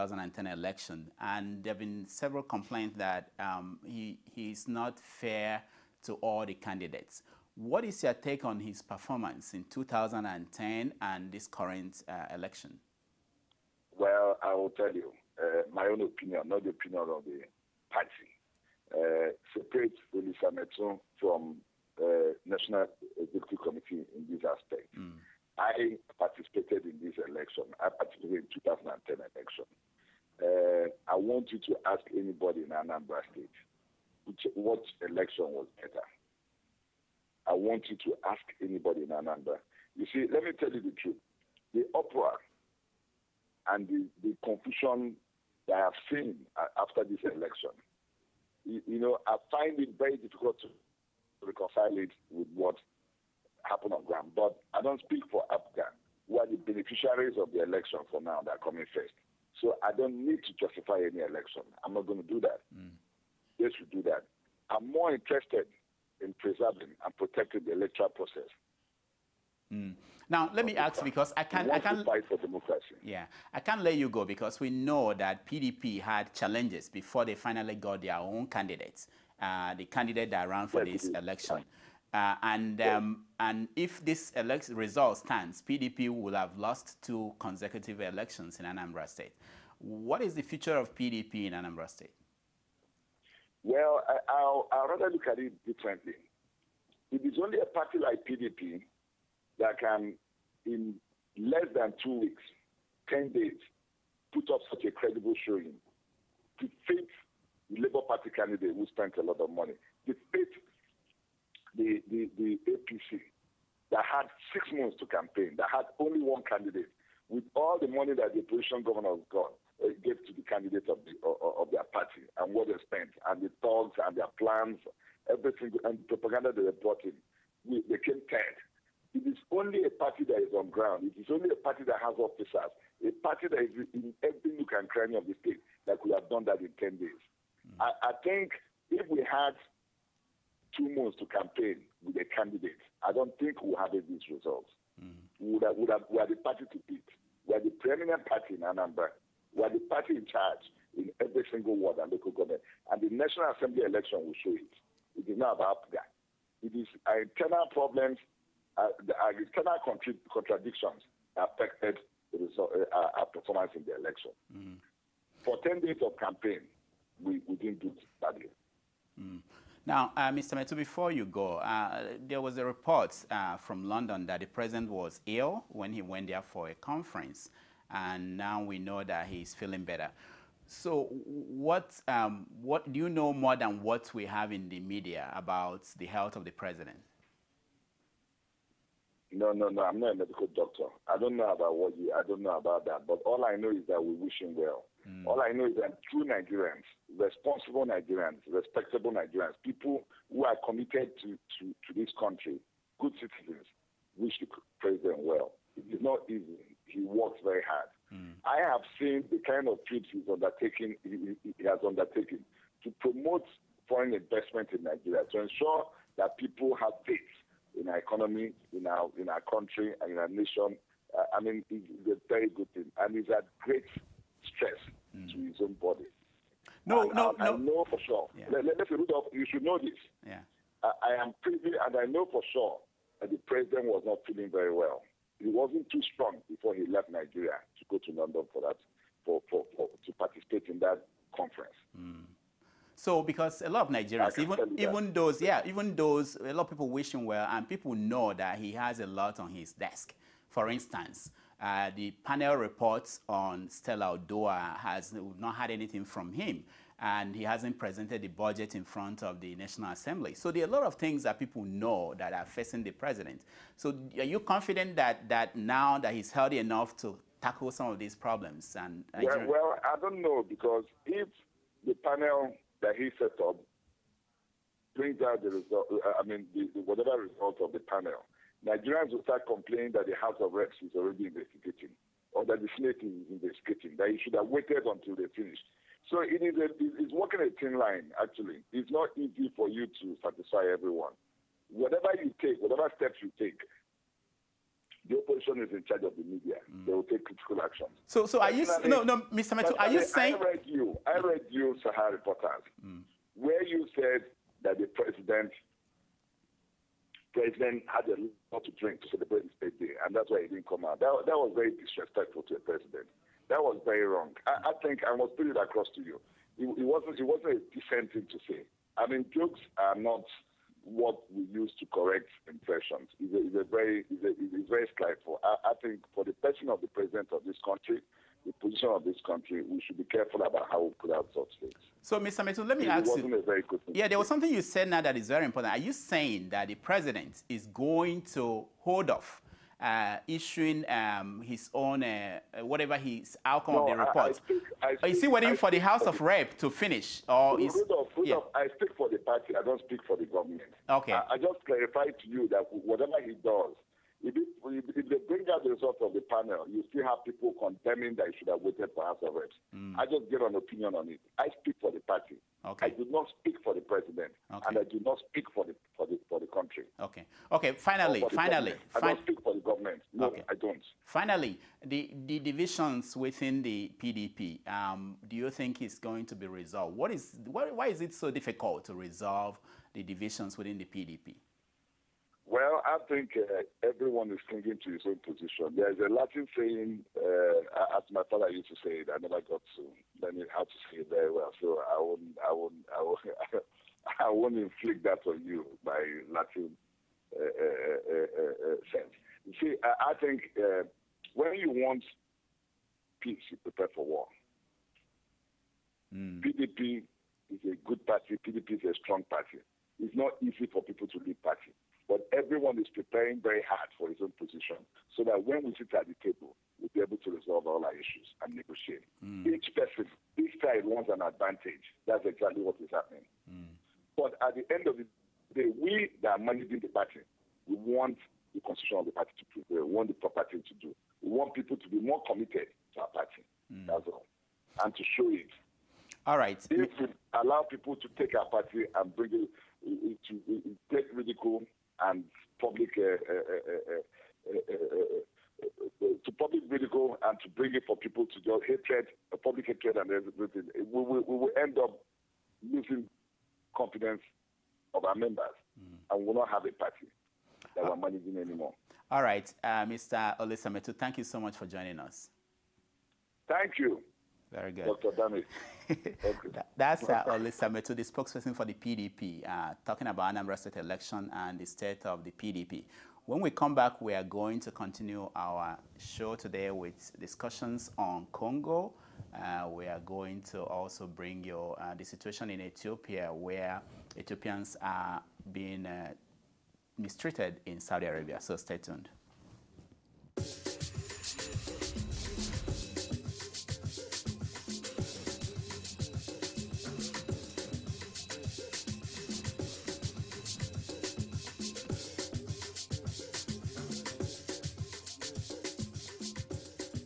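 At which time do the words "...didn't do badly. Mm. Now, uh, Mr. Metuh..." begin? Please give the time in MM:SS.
02:47.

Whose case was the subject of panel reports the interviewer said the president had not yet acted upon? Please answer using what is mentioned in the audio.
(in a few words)
Stella Oduah.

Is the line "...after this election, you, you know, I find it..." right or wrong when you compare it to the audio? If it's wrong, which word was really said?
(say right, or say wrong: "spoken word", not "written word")
right.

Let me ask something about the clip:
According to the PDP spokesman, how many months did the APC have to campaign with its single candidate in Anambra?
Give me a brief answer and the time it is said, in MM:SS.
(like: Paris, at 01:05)
6, at 01:54.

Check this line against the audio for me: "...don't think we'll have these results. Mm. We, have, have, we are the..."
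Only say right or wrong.
right.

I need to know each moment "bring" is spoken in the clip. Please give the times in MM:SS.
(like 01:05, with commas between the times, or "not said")
04:34, 07:19, 07:27, 08:01.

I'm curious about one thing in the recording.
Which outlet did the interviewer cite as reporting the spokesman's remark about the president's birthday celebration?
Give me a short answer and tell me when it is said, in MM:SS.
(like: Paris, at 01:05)
Sahara Reporters, at 05:01.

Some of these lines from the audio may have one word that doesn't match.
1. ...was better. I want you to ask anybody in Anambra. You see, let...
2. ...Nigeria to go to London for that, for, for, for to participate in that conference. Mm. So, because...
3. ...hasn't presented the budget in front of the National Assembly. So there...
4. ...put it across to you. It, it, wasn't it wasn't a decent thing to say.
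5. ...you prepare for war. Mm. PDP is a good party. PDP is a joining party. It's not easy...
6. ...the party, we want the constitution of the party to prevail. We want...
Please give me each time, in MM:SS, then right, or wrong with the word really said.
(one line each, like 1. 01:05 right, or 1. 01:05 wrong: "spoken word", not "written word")
1. 00:35 right
2. 03:57 right
3. 04:17 right
4. 05:15 right
5. 06:43 wrong: "strong", not "joining"
6. 07:06 right.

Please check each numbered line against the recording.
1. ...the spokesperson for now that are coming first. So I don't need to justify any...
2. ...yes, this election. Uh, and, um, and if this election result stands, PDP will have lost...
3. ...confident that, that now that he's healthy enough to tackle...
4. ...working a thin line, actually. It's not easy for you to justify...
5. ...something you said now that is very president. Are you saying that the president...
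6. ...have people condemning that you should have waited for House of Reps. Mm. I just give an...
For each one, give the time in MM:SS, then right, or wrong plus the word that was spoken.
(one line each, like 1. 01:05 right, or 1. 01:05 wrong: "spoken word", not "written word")
1. 00:57 wrong: "election", not "spokesperson"
2. 01:20 right
3. 04:24 right
4. 04:47 wrong: "satisfy", not "justify"
5. 05:34 wrong: "important", not "president"
6. 05:57 right.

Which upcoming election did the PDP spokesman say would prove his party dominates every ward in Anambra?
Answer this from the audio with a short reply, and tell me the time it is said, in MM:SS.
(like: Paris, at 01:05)
National Assembly election, at 02:33.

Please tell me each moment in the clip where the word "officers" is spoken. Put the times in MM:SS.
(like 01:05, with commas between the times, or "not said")
02:12.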